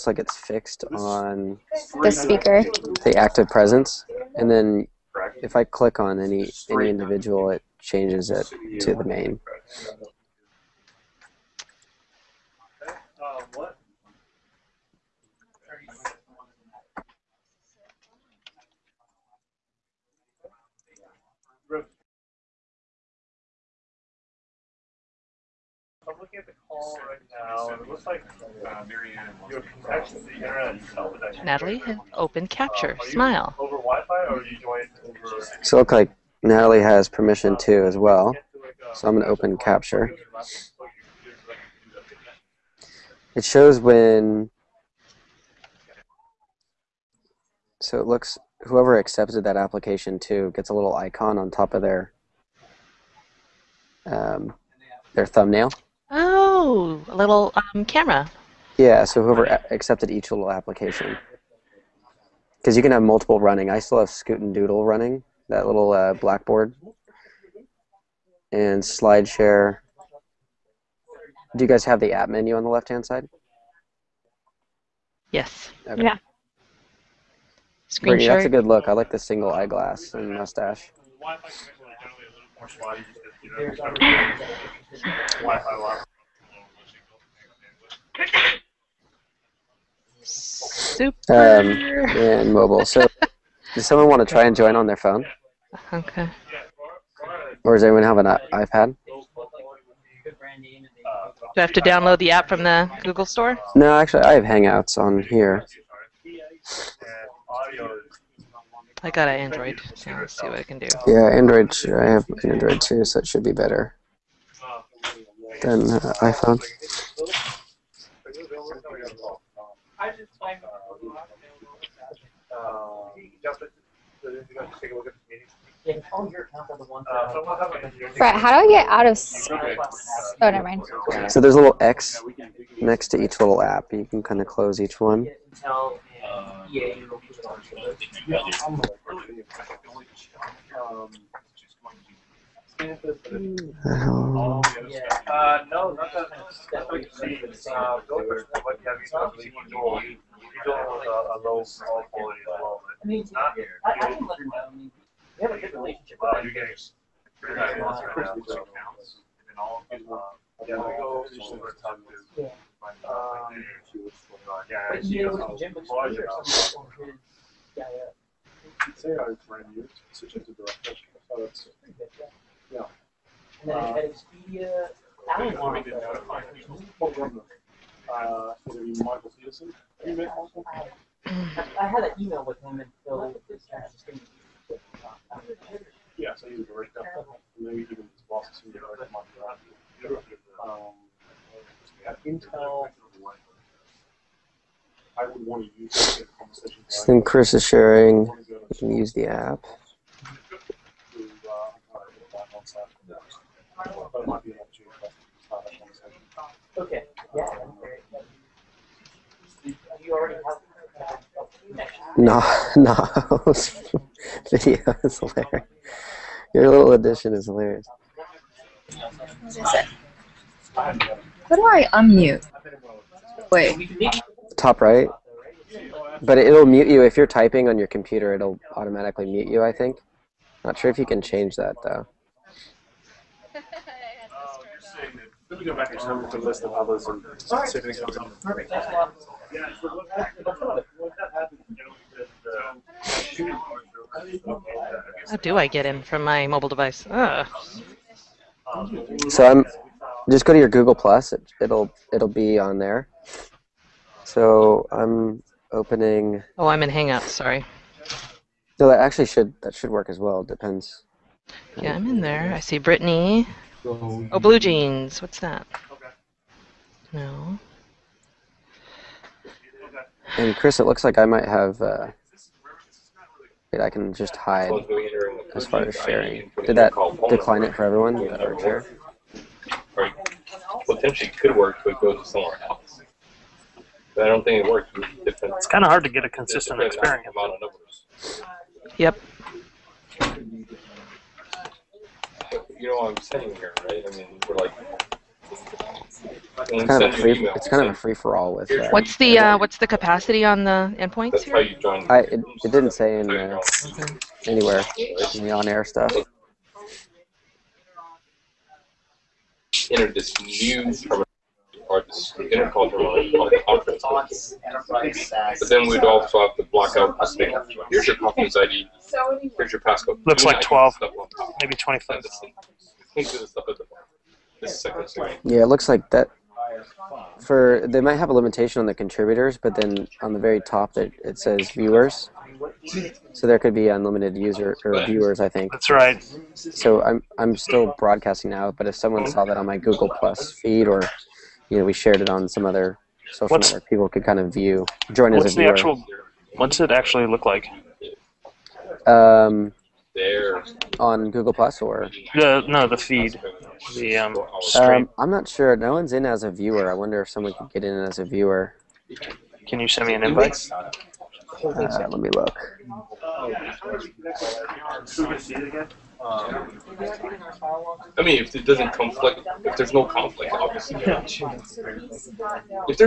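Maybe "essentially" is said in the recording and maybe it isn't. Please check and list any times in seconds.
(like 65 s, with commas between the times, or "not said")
not said.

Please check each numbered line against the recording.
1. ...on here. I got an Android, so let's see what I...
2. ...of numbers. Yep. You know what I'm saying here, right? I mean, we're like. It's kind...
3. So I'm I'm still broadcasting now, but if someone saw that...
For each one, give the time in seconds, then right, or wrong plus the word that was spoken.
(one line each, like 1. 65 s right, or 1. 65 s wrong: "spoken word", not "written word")
1. 104 s right
2. 287 s right
3. 336 s right.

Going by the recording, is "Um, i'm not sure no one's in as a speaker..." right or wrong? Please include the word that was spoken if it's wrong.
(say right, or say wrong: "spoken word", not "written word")
wrong: "viewer", not "speaker".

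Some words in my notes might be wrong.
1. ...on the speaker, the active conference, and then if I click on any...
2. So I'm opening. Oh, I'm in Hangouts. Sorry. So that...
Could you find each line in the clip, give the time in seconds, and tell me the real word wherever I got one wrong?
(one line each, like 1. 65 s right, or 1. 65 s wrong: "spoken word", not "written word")
1. 0 s wrong: "presence", not "conference"
2. 254 s right.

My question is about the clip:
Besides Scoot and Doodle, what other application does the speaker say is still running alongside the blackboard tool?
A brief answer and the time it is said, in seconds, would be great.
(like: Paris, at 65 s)
SlideShare, at 68 s.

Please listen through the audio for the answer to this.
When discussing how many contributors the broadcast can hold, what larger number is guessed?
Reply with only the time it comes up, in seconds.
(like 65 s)
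321 s.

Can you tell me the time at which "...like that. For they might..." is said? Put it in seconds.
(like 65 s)
325 s.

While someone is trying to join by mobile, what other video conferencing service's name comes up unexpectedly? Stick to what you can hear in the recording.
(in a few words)
BlueJeans.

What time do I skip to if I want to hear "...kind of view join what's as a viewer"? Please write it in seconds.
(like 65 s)
344 s.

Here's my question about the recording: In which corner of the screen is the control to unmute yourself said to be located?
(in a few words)
Top right.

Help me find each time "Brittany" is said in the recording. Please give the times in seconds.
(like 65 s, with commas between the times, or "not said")
78 s, 262 s.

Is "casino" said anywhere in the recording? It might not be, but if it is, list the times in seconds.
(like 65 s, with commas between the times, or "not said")
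not said.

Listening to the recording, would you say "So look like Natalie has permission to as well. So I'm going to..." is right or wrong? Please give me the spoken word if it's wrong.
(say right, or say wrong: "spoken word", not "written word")
right.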